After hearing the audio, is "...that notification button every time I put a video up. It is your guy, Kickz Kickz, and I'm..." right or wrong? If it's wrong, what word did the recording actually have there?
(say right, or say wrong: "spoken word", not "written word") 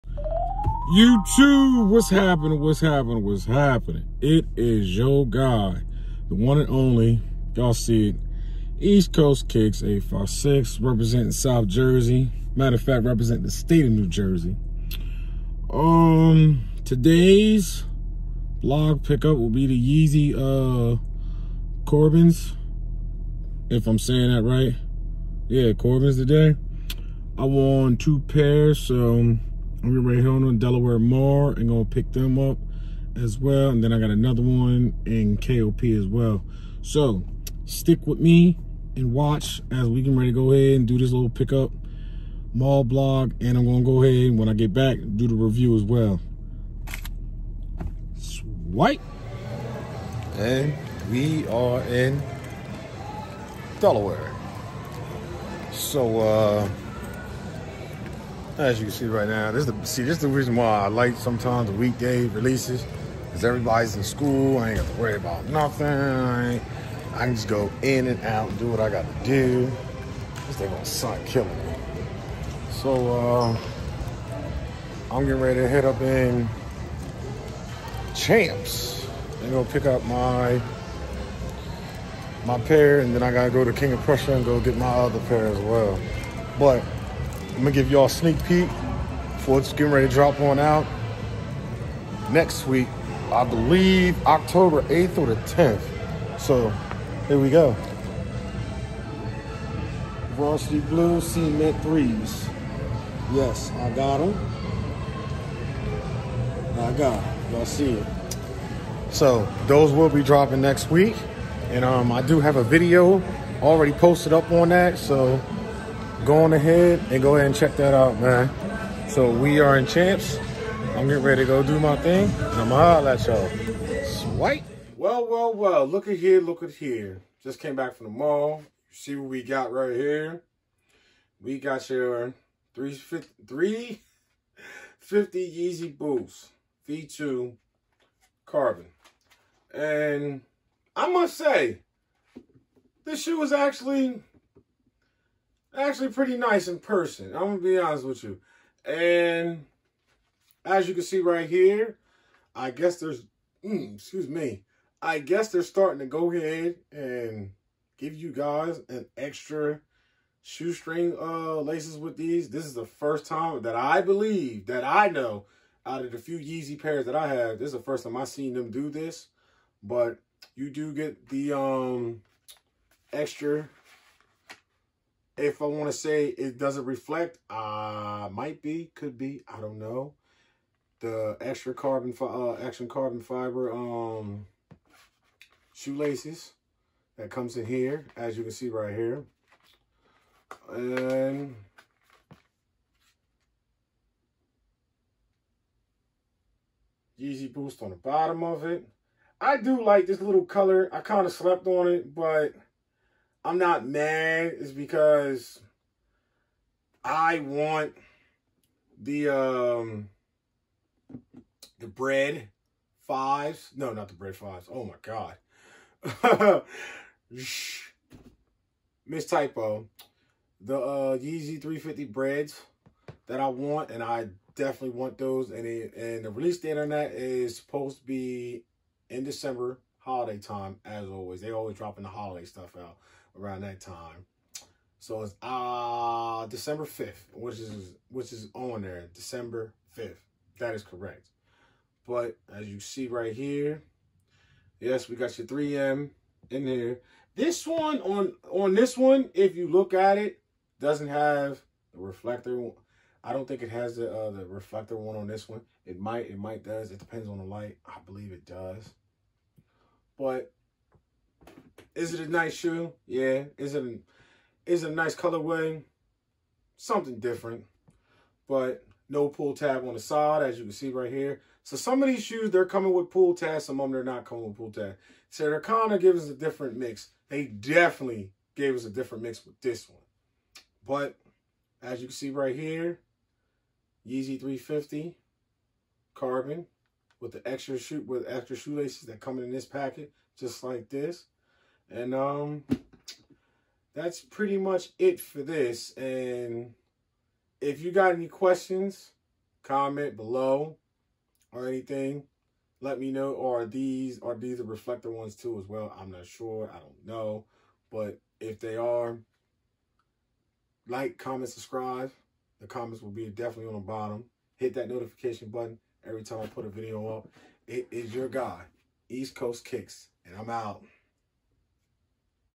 wrong: "EastCoast", not "Kickz".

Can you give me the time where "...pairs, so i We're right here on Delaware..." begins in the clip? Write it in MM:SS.
00:28.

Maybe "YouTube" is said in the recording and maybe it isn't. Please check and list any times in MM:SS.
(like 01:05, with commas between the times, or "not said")
00:00.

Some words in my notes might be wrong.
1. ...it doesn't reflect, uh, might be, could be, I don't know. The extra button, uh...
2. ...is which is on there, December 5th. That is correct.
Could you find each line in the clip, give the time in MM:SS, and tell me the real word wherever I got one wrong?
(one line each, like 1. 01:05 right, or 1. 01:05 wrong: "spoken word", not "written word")
1. 02:56 wrong: "carbon", not "button"
2. 03:57 right.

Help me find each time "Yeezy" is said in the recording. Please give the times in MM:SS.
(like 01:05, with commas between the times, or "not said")
00:20, 02:15, 02:46, 03:17, 03:41, 04:44.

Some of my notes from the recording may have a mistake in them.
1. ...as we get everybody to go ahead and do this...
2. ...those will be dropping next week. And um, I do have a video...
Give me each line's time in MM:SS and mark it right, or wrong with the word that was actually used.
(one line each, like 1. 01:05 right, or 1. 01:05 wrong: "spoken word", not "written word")
1. 00:39 wrong: "ready", not "everybody"
2. 01:49 right.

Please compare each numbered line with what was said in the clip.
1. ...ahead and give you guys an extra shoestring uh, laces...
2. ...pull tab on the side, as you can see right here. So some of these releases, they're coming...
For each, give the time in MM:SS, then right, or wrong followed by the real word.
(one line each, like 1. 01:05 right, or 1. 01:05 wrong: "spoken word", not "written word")
1. 02:36 right
2. 04:29 wrong: "shoes", not "releases".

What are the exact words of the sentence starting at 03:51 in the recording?
They always dropping the holiday stuff out around that time.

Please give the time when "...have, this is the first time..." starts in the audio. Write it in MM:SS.
02:47.